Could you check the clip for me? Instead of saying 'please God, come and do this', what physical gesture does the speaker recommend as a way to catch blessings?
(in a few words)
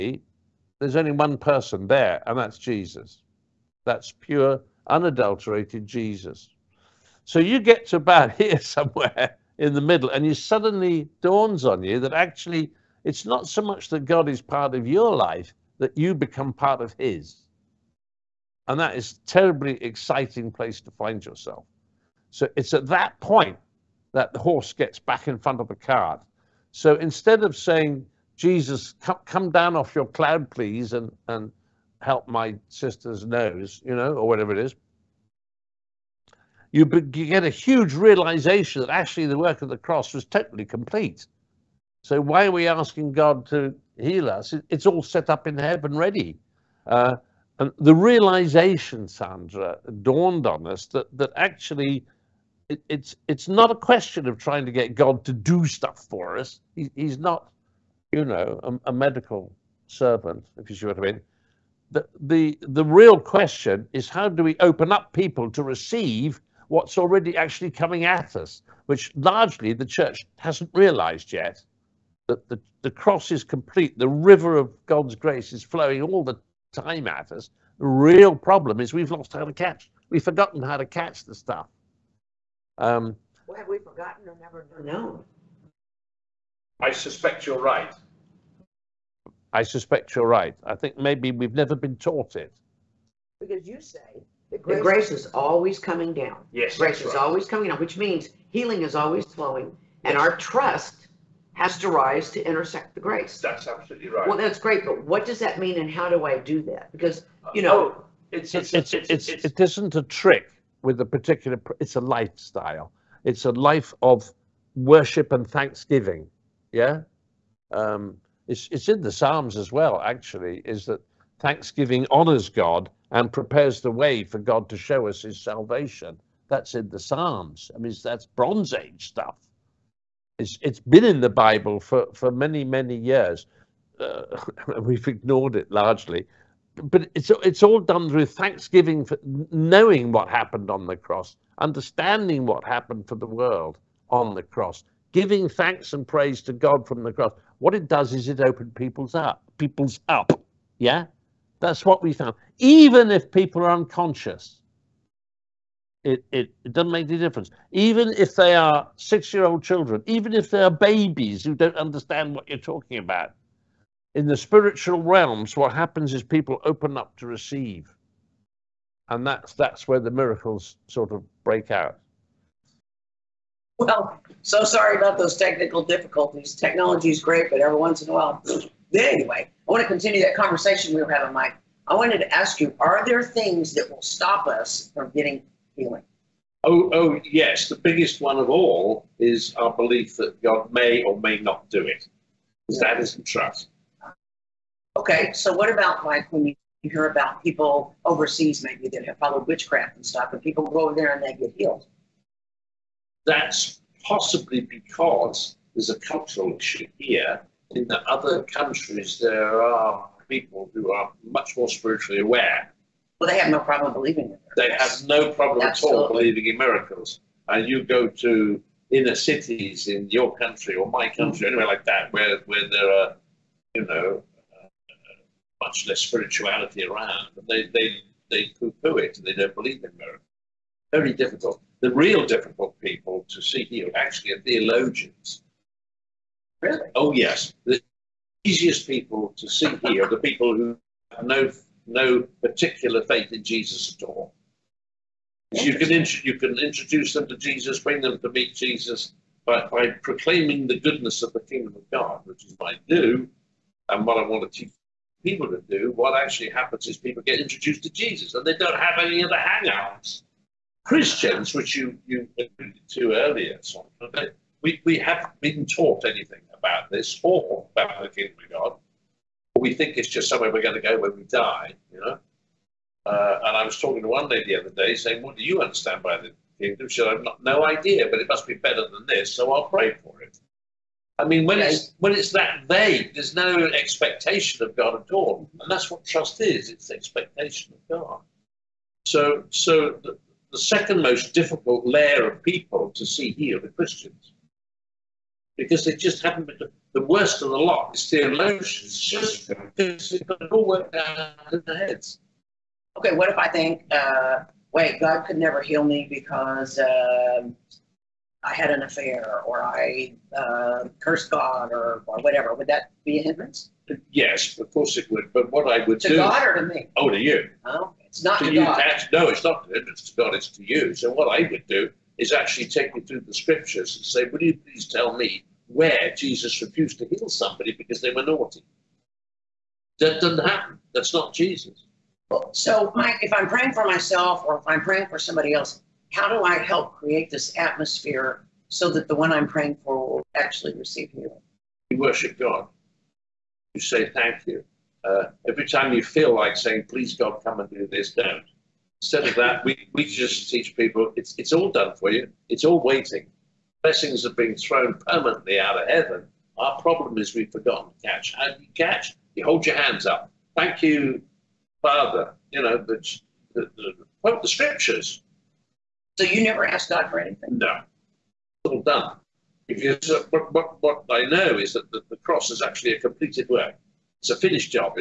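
hold your hands up.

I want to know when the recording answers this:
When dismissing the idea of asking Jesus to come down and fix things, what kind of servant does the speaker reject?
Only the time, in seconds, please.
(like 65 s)
58 s.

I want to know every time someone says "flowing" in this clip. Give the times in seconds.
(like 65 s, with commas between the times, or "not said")
75 s, 99 s.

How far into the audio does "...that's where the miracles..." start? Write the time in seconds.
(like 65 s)
169 s.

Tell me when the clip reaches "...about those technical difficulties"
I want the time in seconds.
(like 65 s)
174 s.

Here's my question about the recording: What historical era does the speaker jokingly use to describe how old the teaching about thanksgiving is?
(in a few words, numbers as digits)
Bronze Age.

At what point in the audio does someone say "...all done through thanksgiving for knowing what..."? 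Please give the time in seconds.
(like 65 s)
137 s.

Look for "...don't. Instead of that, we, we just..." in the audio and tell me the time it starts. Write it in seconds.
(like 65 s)
348 s.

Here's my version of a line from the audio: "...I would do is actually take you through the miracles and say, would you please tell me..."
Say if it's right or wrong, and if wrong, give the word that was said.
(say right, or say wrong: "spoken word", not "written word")
wrong: "scriptures", not "miracles".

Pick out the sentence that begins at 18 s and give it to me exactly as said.
And that is terribly exciting place to find yourself.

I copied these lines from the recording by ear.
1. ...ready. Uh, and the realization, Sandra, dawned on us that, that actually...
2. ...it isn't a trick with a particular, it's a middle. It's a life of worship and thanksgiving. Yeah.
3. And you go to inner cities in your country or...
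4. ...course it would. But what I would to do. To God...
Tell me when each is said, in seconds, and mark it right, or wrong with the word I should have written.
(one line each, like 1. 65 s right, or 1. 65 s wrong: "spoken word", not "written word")
1. 45 s right
2. 109 s wrong: "lifestyle", not "middle"
3. 217 s right
4. 314 s right.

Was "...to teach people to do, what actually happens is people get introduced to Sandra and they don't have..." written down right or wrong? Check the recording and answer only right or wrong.
wrong.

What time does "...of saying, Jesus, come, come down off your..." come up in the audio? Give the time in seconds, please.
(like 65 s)
27 s.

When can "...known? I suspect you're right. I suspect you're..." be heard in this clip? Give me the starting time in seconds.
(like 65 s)
84 s.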